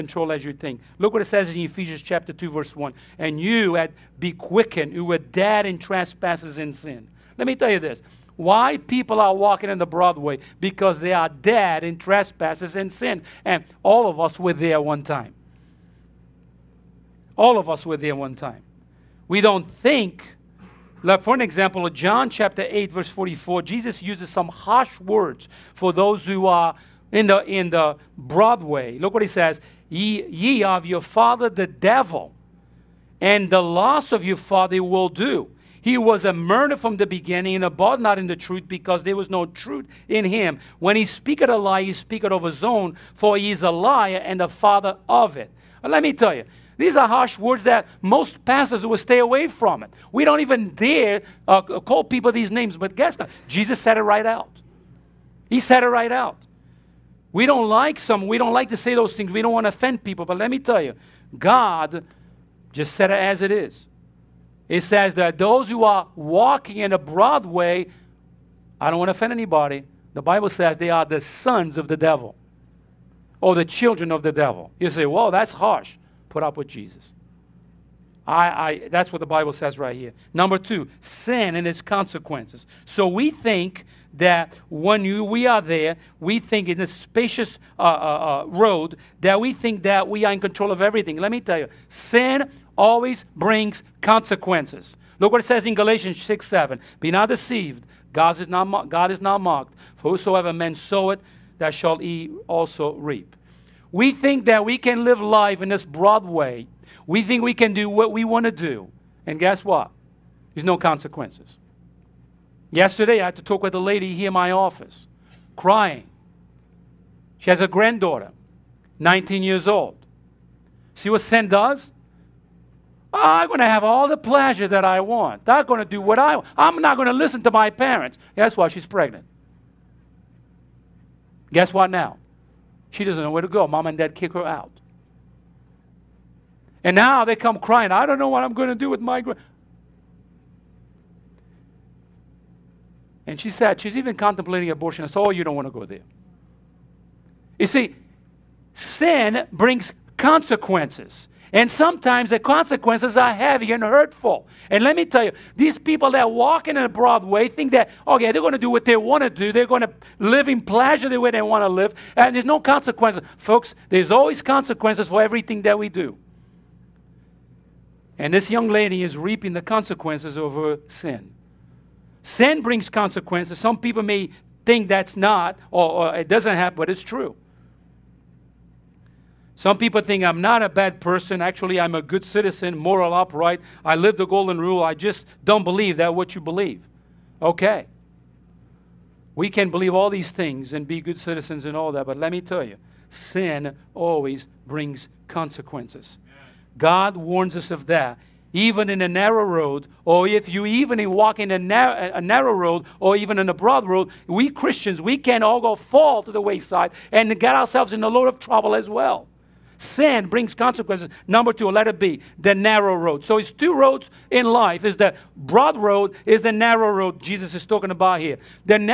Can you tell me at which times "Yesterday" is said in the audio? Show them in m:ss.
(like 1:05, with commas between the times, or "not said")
1:52.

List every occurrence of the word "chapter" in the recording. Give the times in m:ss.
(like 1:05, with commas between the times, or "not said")
0:02, 0:22.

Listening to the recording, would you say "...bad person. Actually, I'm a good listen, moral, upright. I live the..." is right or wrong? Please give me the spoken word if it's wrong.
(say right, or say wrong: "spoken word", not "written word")
wrong: "citizen", not "listen".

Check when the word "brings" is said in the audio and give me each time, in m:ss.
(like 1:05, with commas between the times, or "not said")
1:33, 2:29, 2:52, 3:14, 3:30.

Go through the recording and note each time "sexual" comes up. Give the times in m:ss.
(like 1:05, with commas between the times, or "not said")
not said.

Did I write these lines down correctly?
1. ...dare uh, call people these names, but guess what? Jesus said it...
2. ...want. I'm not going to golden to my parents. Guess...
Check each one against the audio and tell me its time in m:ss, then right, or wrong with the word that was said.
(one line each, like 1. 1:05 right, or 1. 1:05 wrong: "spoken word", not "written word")
1. 0:50 right
2. 2:06 wrong: "listen", not "golden".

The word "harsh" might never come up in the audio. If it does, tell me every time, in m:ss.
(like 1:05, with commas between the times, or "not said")
0:24, 0:47, 1:15.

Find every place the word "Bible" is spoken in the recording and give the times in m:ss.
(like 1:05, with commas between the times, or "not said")
1:10, 1:19.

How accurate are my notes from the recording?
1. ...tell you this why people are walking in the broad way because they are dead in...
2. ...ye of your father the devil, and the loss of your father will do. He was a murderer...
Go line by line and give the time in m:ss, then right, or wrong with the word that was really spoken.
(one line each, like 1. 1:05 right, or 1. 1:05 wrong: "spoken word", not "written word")
1. 0:07 right
2. 0:30 right.